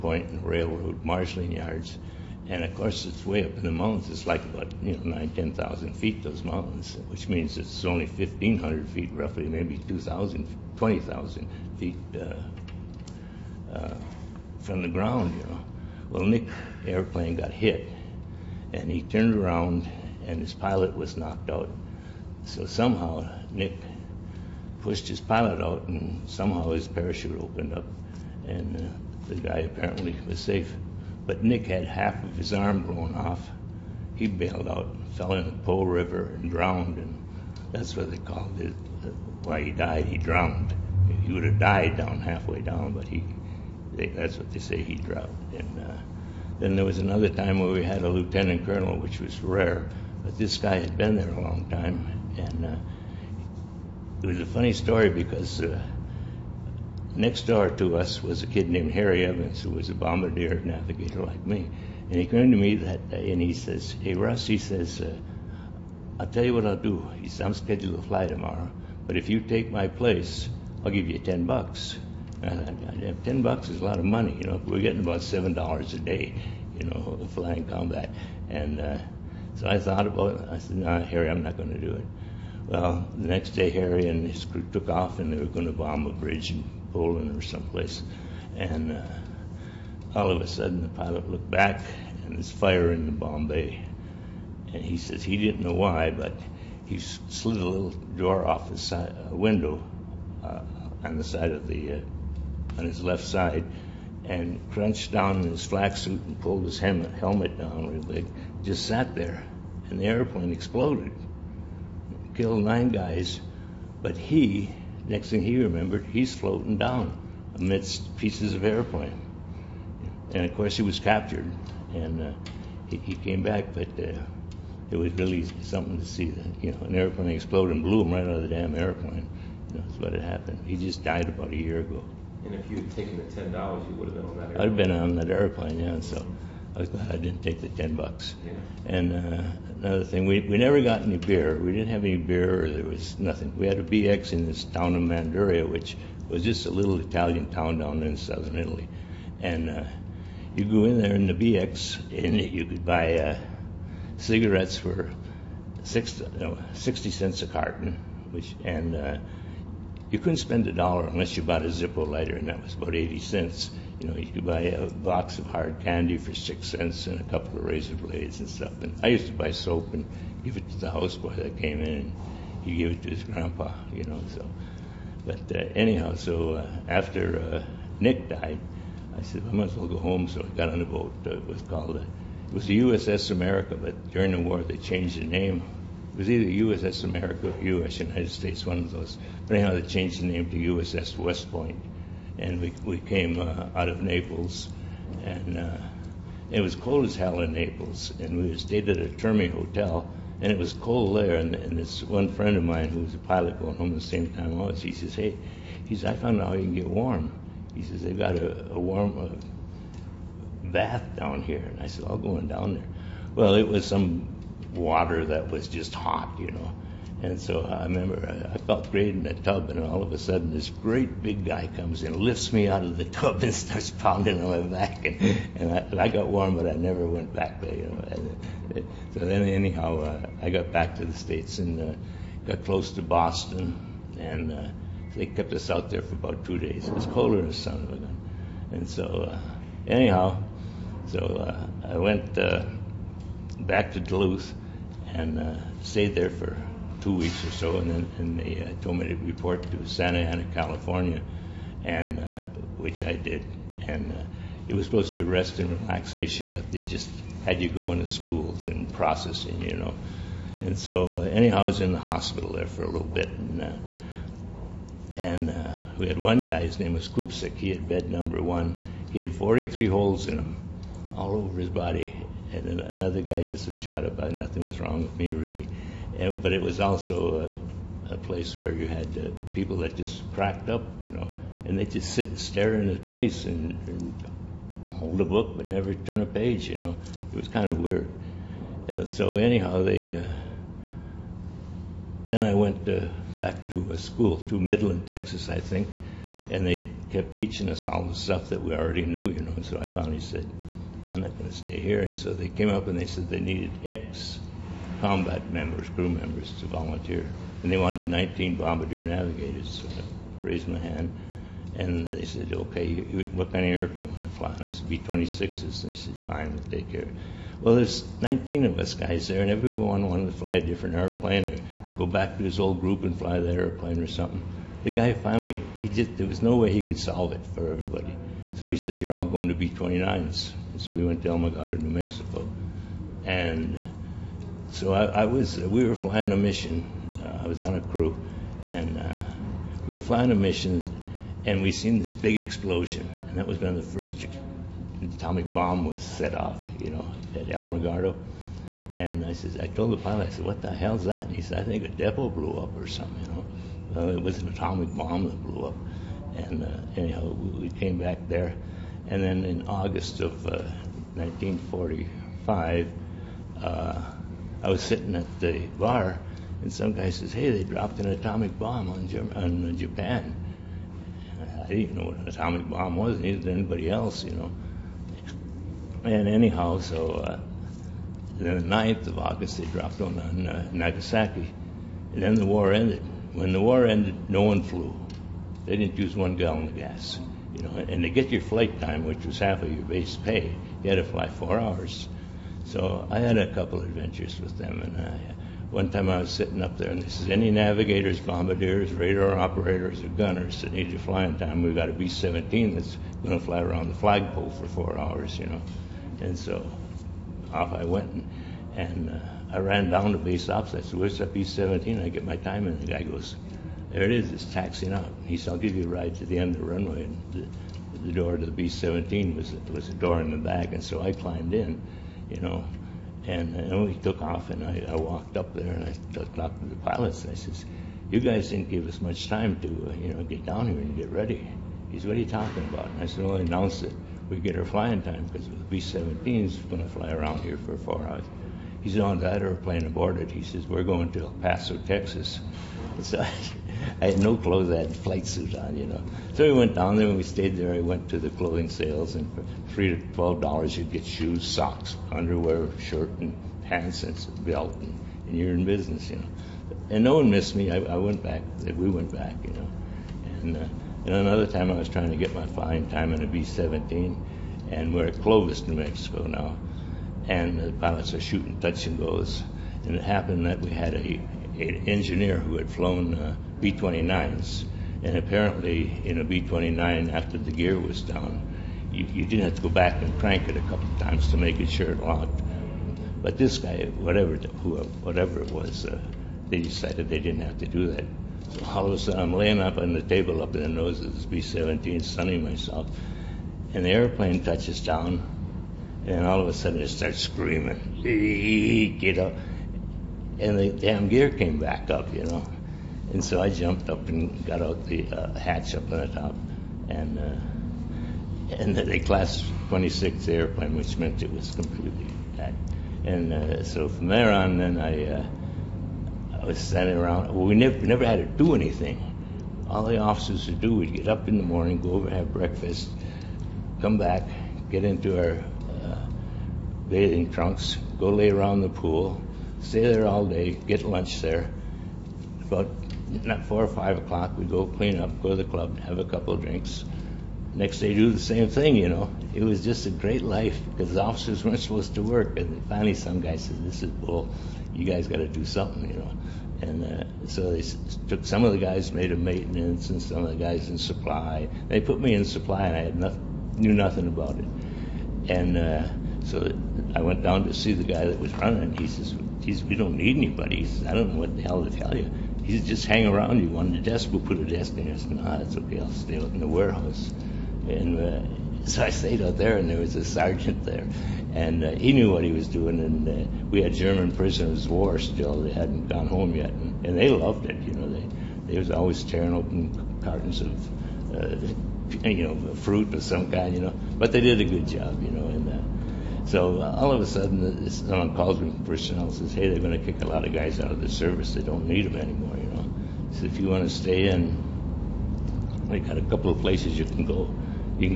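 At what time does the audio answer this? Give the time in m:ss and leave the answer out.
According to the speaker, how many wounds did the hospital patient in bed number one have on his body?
4:29.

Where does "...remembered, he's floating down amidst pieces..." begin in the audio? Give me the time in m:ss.
1:55.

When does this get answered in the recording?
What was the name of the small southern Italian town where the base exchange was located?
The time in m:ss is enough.
2:25.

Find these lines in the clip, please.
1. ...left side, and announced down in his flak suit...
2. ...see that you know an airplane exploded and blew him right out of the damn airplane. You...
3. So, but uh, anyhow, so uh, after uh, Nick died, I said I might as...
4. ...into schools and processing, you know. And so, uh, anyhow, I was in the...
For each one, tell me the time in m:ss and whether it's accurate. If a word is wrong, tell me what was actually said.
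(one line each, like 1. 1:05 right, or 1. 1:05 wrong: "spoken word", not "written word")
1. 1:43 wrong: "crunched", not "announced"
2. 2:06 right
3. 2:54 right
4. 4:17 right.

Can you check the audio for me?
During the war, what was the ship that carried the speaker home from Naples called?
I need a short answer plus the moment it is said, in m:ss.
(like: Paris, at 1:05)
USS West Point, at 3:10.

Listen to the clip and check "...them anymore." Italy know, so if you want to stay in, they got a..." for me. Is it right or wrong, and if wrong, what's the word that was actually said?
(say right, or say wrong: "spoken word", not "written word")
wrong: "You", not "Italy".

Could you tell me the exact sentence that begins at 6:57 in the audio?
And the, the door to the B-17 was, was a door in the back, and so I climbed in you know.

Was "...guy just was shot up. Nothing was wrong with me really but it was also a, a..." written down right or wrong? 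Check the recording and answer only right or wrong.
right.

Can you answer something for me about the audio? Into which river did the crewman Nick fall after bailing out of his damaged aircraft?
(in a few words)
Po River.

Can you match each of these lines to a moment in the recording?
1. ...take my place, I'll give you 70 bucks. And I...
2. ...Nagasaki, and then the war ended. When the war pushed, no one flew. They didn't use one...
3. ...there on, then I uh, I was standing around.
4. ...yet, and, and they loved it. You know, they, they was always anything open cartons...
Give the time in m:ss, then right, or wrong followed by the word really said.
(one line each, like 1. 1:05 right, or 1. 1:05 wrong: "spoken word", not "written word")
1. 1:09 wrong: "10", not "70"
2. 6:20 wrong: "ended", not "pushed"
3. 8:34 right
4. 9:36 wrong: "tearing", not "anything".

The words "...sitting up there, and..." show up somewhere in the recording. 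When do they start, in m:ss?
6:36.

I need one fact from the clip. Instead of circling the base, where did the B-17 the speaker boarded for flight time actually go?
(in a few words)
El Paso, Texas.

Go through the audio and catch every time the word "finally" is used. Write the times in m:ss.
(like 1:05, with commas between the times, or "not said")
4:59, 5:25, 9:02.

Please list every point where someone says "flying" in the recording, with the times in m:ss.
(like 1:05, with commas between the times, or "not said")
1:17, 5:35, 5:39, 7:14, 7:42.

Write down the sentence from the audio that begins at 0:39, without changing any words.
Uh, why he died, he drowned.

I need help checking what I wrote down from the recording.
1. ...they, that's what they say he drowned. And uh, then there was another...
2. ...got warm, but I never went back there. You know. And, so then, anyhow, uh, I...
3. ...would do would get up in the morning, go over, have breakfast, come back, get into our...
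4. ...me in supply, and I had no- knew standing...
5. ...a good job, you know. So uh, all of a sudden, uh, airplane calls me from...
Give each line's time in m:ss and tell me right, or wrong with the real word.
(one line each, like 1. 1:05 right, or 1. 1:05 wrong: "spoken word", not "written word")
1. 0:43 right
2. 3:46 right
3. 8:40 right
4. 9:11 wrong: "nothing", not "standing"
5. 9:44 wrong: "someone", not "airplane".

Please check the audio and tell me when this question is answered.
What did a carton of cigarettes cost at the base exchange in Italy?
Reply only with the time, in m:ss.
2:36.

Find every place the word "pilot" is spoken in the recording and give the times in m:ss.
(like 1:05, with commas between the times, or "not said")
0:20, 0:25, 1:30, 3:23, 5:49, 7:06, 7:47.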